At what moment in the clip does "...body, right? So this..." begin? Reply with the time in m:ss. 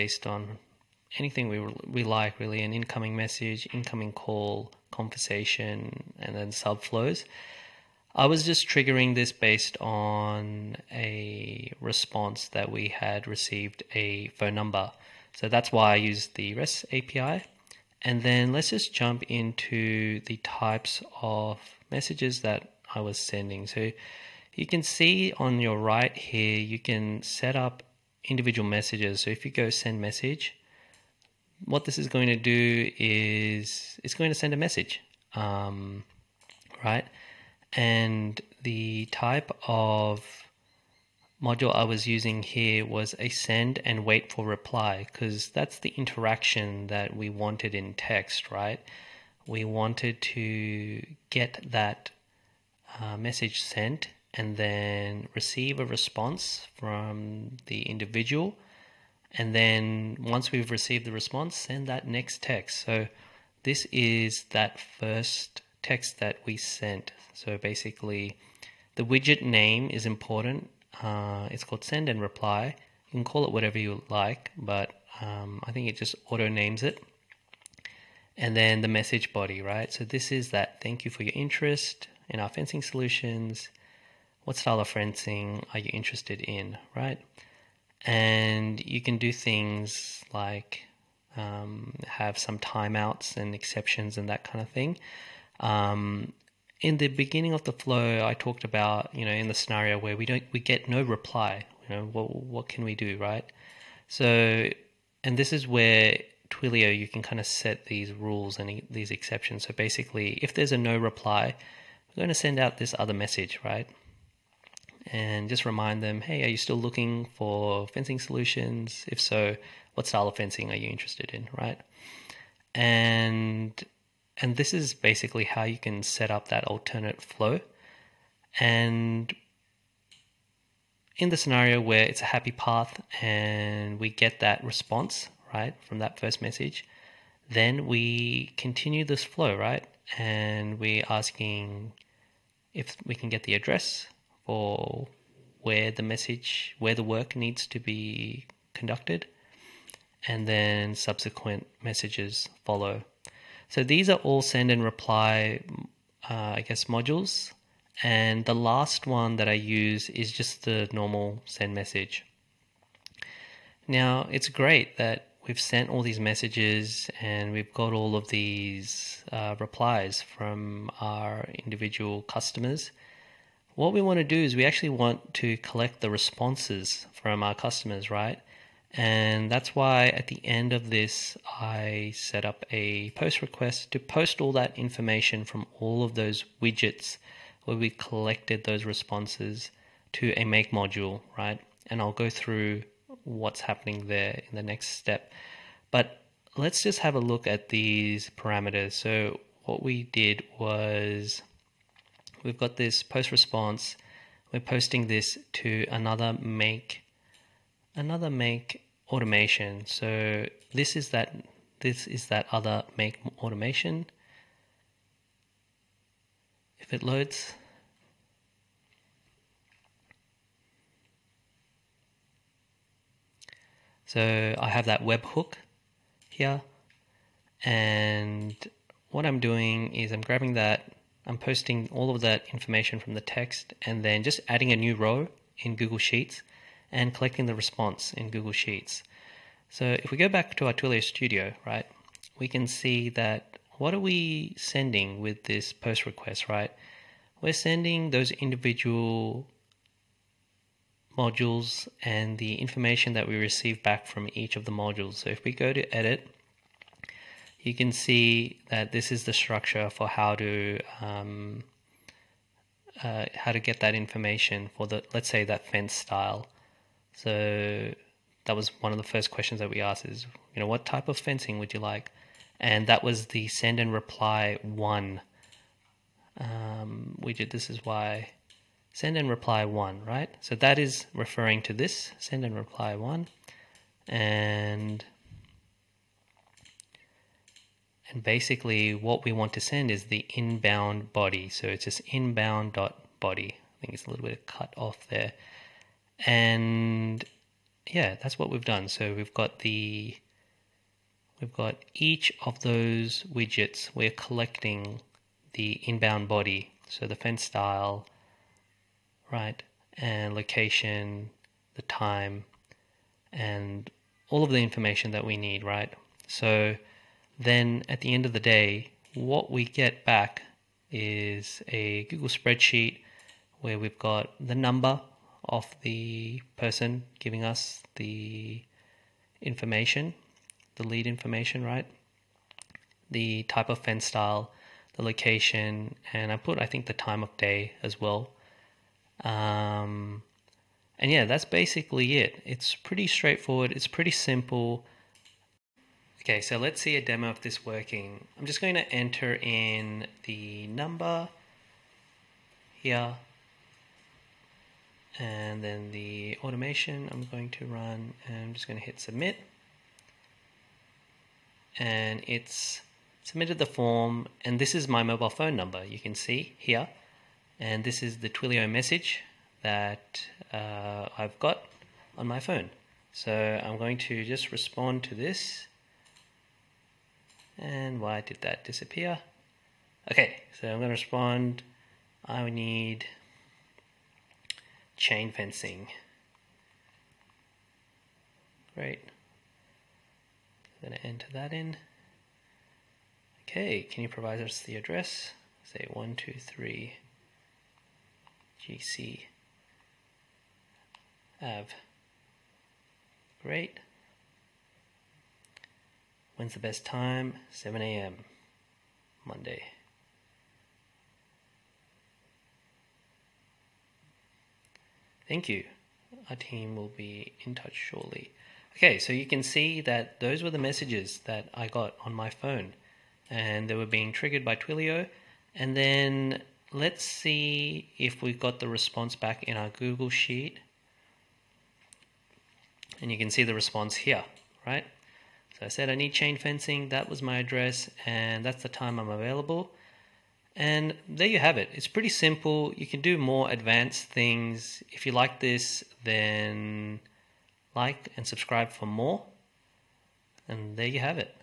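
1:19.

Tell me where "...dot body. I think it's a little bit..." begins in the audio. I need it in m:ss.
4:52.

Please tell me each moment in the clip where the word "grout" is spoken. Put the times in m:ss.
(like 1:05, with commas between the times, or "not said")
not said.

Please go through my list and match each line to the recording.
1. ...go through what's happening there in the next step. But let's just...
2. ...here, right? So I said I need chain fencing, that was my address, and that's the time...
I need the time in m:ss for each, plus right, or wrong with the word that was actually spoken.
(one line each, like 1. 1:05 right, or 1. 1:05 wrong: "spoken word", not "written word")
1. 3:12 right
2. 7:13 right.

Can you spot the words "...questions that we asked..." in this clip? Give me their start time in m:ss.
4:29.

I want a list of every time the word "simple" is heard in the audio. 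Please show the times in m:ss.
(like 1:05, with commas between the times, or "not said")
5:44, 7:22.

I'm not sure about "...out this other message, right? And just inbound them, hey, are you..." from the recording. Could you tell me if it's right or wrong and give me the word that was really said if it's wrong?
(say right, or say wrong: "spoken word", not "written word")
wrong: "remind", not "inbound".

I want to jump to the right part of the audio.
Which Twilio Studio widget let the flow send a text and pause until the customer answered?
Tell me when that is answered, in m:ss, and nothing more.
0:43.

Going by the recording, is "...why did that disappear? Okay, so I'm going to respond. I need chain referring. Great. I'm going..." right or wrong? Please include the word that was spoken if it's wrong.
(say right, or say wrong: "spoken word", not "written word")
wrong: "fencing", not "referring".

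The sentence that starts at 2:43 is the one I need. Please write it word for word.
Now, it's great that we've sent all these messages and we've got all of these uh, replies from our individual customers.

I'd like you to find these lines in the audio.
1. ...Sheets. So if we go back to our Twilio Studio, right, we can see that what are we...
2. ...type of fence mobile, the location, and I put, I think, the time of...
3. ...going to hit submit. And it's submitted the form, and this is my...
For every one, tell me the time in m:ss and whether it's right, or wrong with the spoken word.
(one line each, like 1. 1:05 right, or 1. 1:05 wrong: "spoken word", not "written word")
1. 3:58 right
2. 5:33 wrong: "style", not "mobile"
3. 5:58 right.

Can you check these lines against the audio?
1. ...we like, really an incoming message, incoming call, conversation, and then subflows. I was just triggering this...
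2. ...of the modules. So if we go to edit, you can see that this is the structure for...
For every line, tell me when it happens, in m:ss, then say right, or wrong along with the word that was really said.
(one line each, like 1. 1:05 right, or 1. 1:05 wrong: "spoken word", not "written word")
1. 0:01 right
2. 4:14 right.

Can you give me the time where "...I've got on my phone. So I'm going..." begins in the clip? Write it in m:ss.
6:11.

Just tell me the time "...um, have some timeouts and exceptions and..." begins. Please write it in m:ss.
1:31.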